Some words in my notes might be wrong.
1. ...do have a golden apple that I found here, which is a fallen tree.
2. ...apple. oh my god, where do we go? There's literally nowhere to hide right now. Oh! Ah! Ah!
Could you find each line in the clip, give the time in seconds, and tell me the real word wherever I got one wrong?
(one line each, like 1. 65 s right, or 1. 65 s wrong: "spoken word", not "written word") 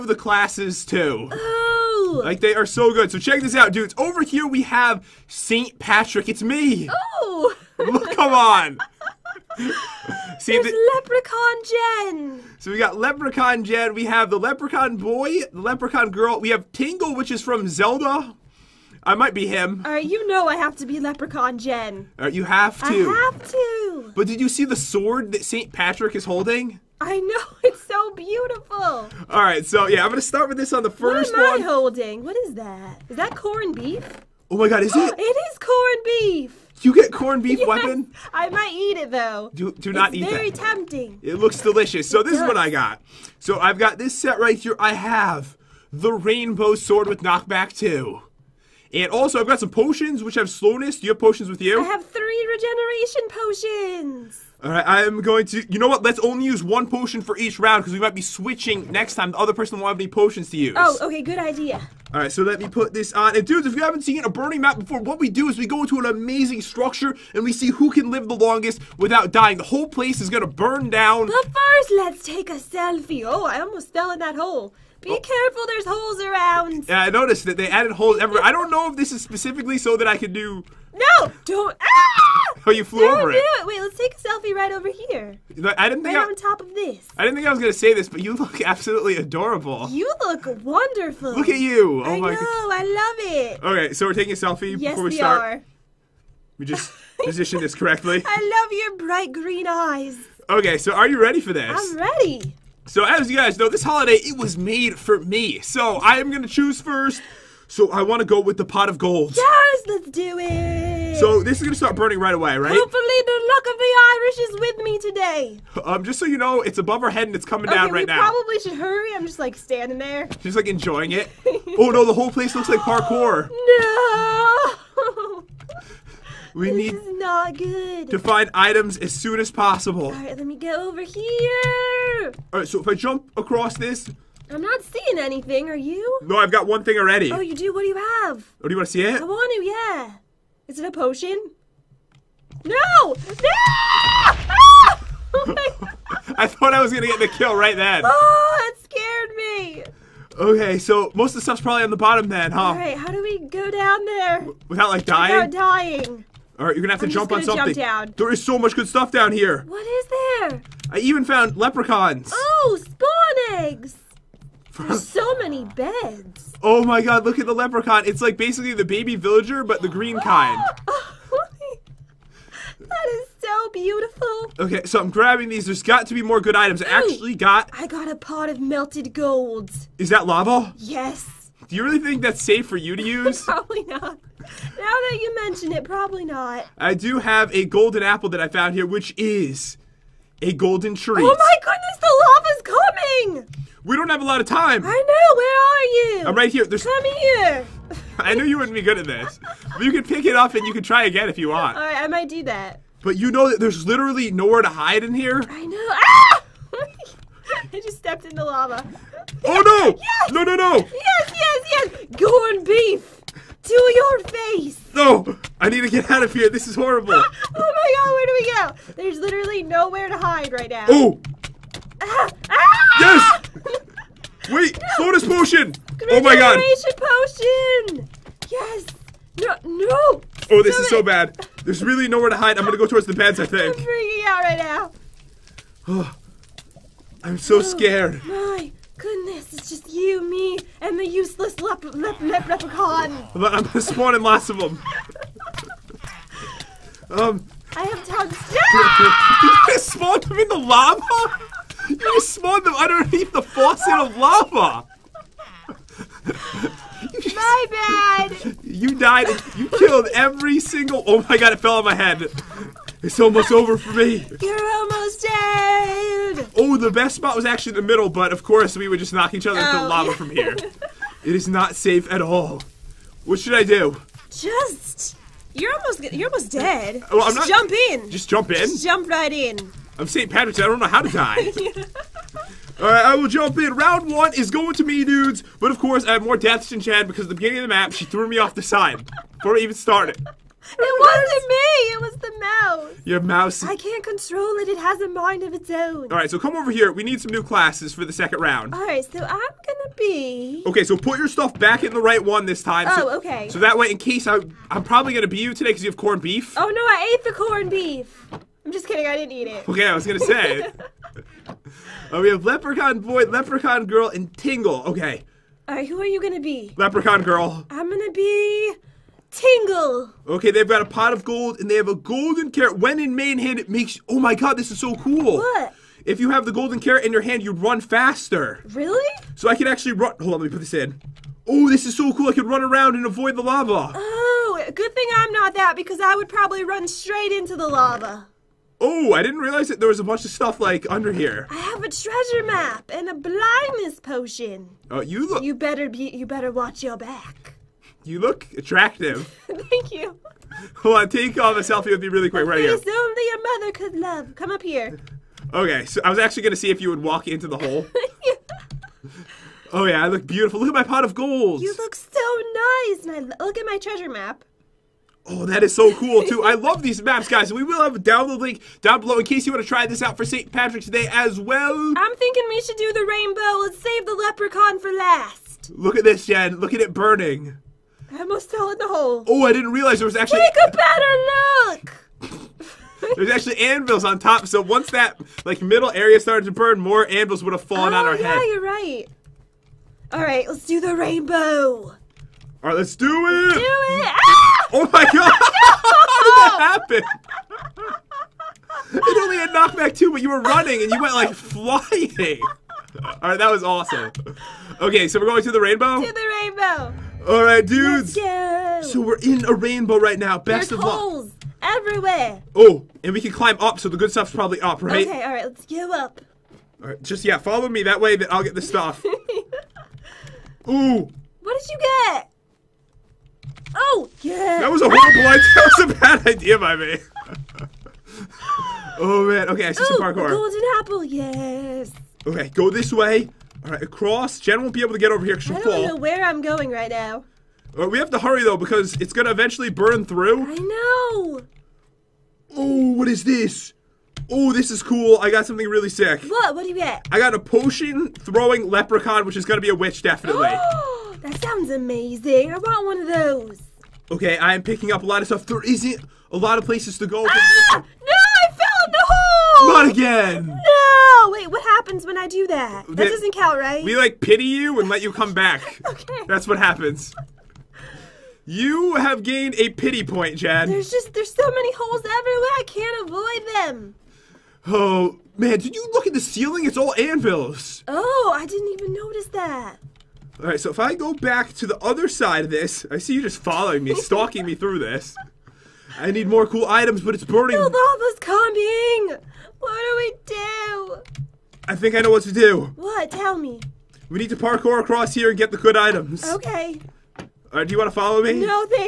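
1. 186 s wrong: "golden", not "fallen"
2. 216 s wrong: "horrible", not "apple".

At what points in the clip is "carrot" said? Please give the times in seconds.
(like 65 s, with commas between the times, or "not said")
322 s, 326 s.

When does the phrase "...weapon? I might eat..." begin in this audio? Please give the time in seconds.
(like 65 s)
37 s.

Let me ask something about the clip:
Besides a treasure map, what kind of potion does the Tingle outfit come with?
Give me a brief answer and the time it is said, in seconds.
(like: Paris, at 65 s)
Blindness potion, at 343 s.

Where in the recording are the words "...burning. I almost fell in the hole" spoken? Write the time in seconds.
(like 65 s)
376 s.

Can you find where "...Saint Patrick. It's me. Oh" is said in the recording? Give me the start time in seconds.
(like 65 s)
5 s.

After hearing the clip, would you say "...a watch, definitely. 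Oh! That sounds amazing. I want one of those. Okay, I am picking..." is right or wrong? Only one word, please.
wrong.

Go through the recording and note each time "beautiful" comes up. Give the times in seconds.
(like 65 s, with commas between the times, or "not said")
28 s, 173 s, 360 s.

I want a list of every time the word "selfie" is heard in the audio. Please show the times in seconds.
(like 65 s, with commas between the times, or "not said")
72 s, 84 s, 94 s, 351 s.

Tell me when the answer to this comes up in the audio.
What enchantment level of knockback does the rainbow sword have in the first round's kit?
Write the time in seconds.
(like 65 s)
47 s.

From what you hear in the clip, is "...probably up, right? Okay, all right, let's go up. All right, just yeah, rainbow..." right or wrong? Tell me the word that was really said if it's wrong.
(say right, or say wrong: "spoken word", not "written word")
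wrong: "follow", not "rainbow".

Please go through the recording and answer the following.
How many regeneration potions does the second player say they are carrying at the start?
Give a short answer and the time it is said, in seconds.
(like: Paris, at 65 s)
3, at 52 s.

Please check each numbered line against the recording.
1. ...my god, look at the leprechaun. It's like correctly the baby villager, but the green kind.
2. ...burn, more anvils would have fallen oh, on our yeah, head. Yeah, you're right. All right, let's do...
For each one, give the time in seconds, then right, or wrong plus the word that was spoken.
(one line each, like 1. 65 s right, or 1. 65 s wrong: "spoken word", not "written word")
1. 166 s wrong: "basically", not "correctly"
2. 386 s right.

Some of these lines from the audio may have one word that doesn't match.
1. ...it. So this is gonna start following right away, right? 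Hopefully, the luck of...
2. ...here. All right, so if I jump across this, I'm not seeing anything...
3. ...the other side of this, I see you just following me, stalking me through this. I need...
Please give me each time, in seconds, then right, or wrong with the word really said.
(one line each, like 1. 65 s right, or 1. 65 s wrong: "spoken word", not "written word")
1. 110 s wrong: "burning", not "following"
2. 131 s right
3. 481 s right.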